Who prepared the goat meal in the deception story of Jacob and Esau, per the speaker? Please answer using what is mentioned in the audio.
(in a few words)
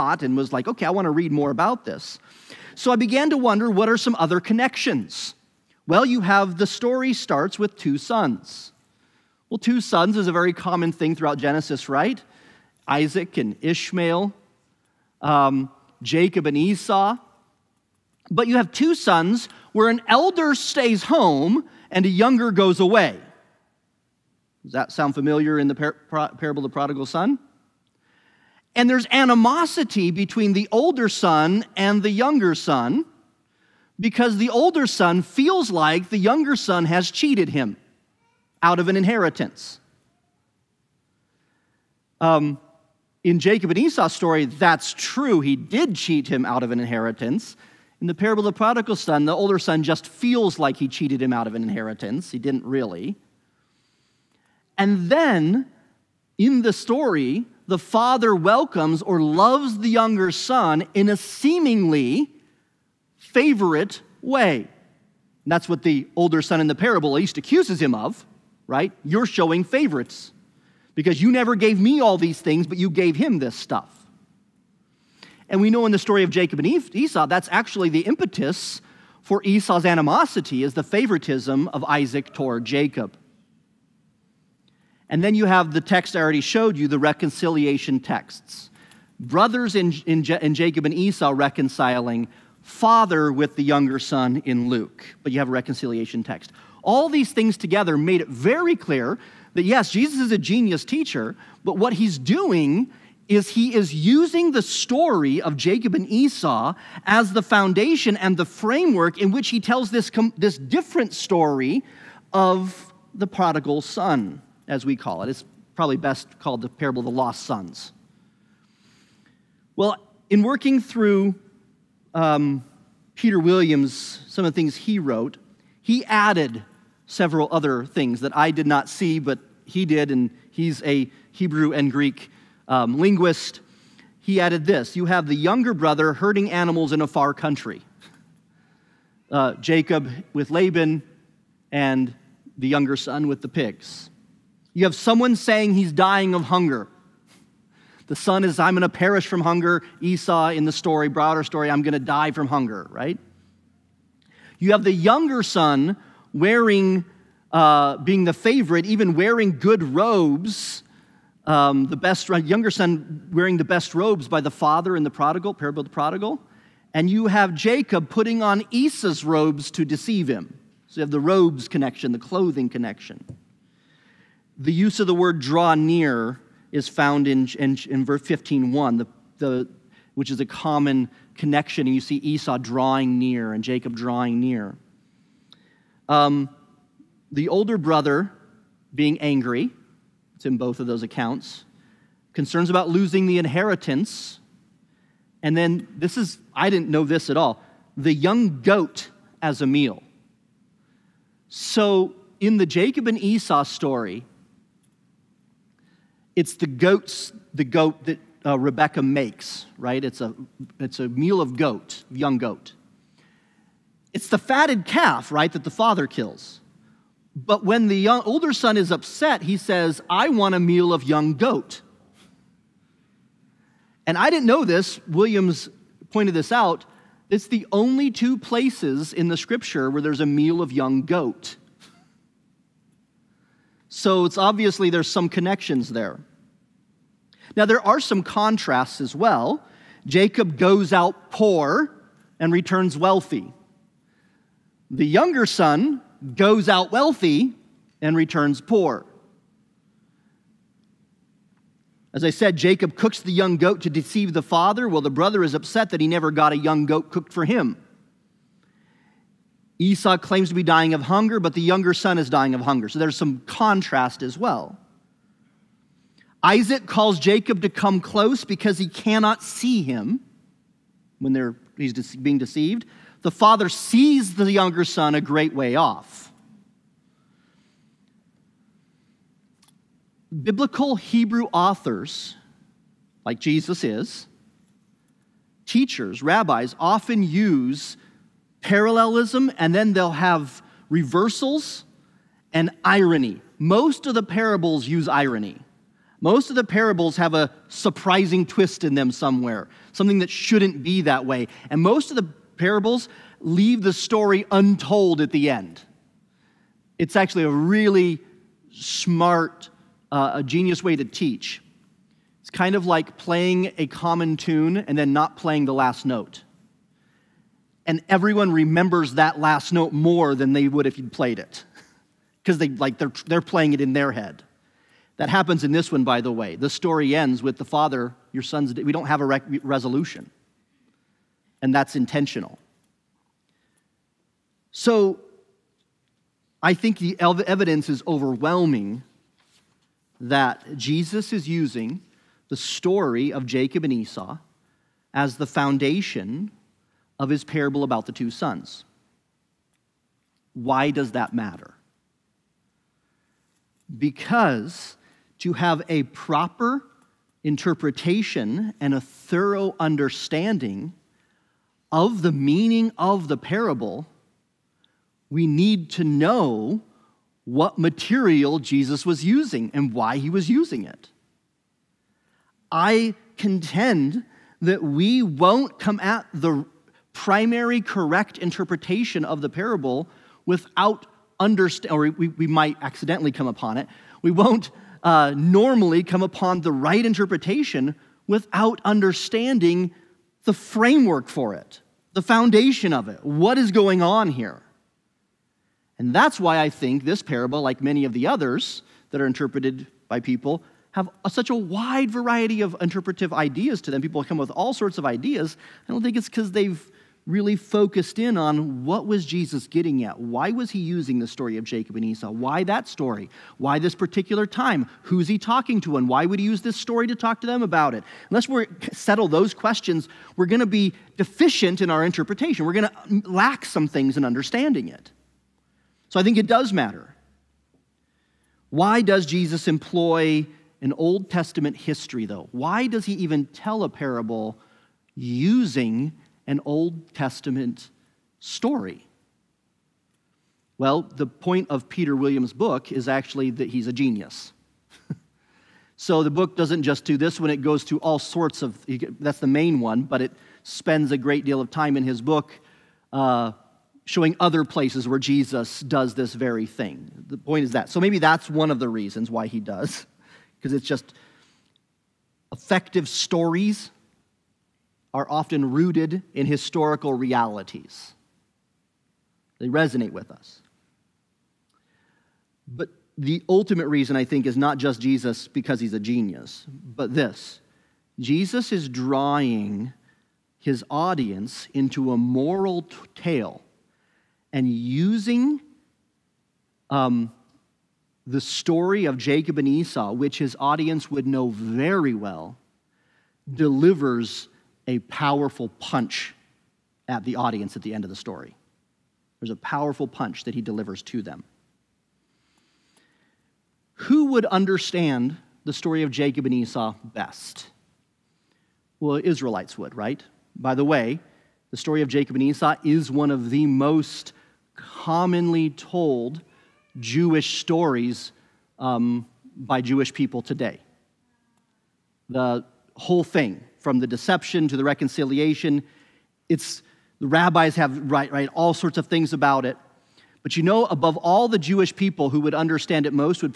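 Rebecca.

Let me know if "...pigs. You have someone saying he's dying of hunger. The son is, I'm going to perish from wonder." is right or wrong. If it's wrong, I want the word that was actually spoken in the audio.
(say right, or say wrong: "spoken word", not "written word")
wrong: "hunger", not "wonder".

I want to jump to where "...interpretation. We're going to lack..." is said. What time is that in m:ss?
7:02.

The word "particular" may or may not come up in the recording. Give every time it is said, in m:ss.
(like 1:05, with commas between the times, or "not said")
6:53.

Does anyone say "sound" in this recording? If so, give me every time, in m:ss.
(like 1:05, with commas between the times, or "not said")
0:24.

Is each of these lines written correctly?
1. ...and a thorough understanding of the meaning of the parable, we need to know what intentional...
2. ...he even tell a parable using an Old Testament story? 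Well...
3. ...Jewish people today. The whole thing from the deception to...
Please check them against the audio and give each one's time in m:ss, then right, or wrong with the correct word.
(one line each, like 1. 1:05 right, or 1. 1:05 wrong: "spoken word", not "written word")
1. 5:58 wrong: "material", not "intentional"
2. 7:13 right
3. 8:39 right.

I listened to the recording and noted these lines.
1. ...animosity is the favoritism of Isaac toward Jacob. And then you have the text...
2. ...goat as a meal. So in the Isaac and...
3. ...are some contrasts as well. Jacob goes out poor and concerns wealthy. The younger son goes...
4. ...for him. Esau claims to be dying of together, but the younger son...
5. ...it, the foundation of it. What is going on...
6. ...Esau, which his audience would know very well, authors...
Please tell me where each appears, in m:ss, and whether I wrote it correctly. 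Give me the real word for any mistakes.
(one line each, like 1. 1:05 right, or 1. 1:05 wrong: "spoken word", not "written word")
1. 1:19 right
2. 3:18 wrong: "Jacob", not "Isaac"
3. 3:57 wrong: "returns", not "concerns"
4. 4:17 wrong: "hunger", not "together"
5. 6:31 right
6. 8:09 wrong: "delivers", not "authors".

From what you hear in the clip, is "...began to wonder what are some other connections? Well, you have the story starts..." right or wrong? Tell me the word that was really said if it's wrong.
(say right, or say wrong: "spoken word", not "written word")
right.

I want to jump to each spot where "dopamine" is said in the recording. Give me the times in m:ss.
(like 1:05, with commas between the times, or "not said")
not said.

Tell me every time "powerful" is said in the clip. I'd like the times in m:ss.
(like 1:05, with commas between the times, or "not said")
8:14, 8:19.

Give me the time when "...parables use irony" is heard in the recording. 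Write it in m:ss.
4:54.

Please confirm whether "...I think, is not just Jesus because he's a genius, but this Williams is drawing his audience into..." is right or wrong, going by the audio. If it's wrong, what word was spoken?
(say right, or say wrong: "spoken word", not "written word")
wrong: "Jesus", not "Williams".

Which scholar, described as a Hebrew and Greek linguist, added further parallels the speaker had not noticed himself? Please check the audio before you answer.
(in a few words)
Peter Williams.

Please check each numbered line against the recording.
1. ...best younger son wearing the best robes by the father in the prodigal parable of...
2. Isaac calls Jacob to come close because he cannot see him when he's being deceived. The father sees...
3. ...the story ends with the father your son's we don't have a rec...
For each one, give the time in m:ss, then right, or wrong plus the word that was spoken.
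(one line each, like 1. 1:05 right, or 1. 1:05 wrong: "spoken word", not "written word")
1. 2:41 right
2. 4:26 right
3. 5:26 right.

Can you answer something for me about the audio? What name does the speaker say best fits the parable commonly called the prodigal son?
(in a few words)
The parable of the lost sons.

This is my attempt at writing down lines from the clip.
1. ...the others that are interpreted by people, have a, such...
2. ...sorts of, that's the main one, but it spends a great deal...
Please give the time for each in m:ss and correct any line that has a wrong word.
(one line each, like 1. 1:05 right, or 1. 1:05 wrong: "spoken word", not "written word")
1. 6:38 right
2. 7:28 right.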